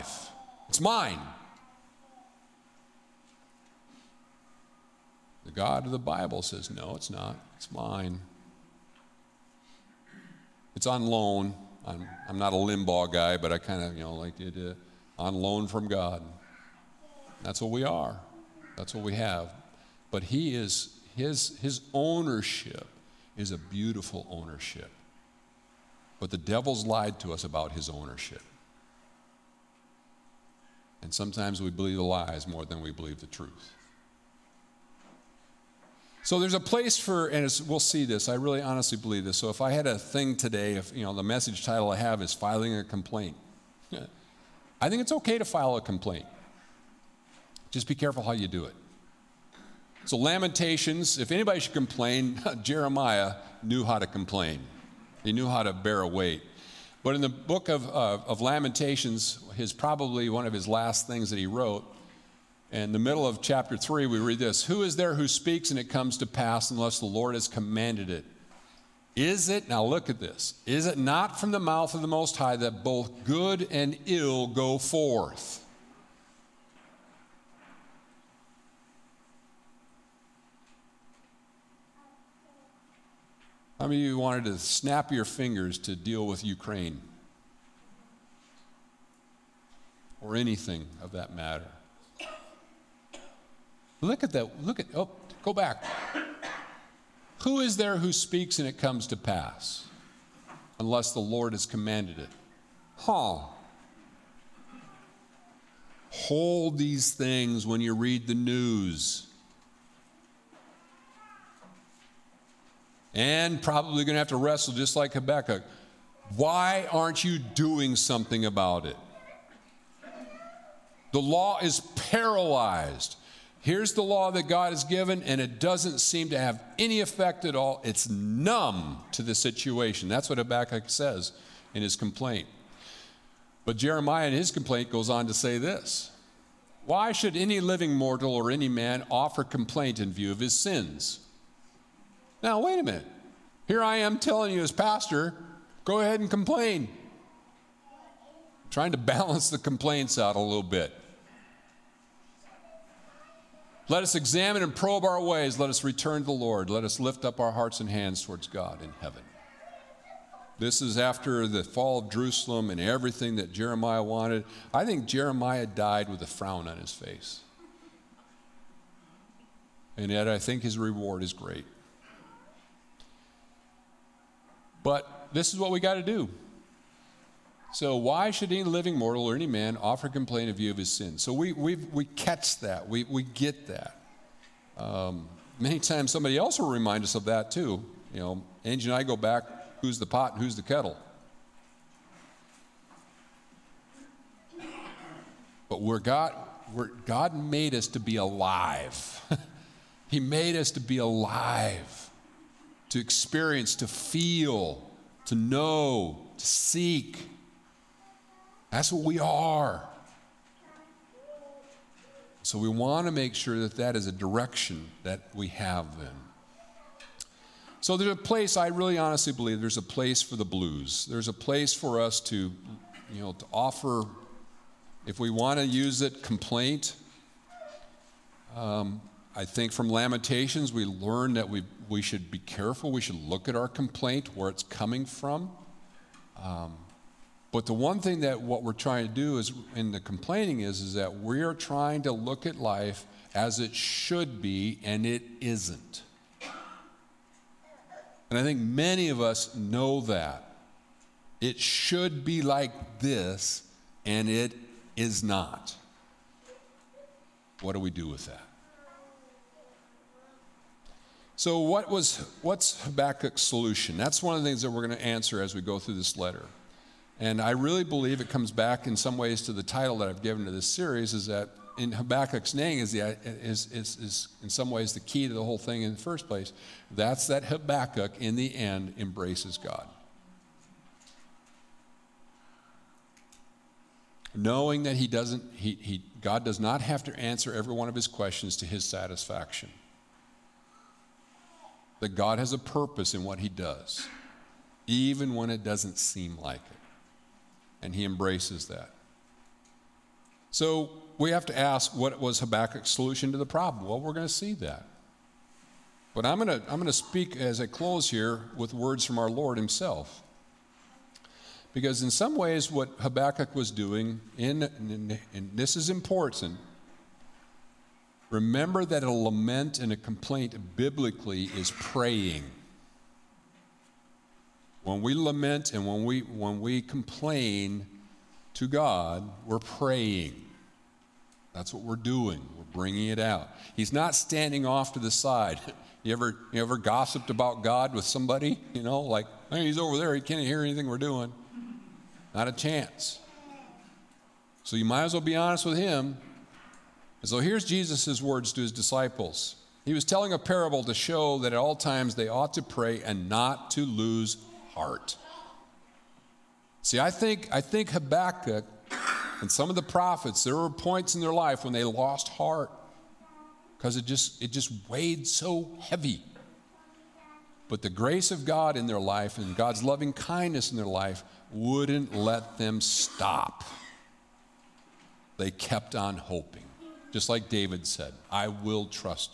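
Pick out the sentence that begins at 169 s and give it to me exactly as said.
And yet, I think his reward is great.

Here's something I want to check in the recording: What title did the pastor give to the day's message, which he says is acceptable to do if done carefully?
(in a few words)
Filing a complaint.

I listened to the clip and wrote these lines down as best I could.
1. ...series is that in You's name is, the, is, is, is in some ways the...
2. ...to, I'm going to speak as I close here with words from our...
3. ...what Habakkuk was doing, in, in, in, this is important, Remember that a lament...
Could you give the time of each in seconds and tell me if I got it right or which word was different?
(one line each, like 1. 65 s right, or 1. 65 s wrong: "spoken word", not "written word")
1. 270 s wrong: "Habakkuk", not "You"
2. 306 s right
3. 312 s right.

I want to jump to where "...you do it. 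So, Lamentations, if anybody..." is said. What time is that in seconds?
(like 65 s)
48 s.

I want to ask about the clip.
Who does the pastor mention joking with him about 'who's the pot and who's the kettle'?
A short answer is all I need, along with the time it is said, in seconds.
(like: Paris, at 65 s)
Angie, at 188 s.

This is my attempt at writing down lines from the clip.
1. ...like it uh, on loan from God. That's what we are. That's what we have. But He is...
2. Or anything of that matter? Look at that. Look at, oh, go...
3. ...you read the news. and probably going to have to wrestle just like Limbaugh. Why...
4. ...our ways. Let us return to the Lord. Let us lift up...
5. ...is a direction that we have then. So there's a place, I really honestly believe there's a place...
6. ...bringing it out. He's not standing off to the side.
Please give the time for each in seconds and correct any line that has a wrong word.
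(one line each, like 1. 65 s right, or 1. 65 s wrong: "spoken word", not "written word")
1. 14 s right
2. 90 s right
3. 107 s wrong: "Habakkuk", not "Limbaugh"
4. 155 s right
5. 213 s right
6. 332 s right.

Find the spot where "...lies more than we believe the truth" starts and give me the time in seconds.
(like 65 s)
32 s.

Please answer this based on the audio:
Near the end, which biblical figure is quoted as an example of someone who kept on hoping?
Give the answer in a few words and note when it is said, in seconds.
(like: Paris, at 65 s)
David, at 377 s.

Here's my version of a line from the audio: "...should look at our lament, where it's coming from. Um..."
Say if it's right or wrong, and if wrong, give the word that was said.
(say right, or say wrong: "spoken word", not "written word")
wrong: "complaint", not "lament".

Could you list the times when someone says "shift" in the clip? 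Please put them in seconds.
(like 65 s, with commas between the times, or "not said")
not said.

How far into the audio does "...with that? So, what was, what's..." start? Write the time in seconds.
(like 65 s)
258 s.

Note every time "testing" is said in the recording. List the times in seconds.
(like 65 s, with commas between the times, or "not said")
not said.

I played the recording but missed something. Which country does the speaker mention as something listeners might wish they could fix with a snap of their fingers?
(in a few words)
Ukraine.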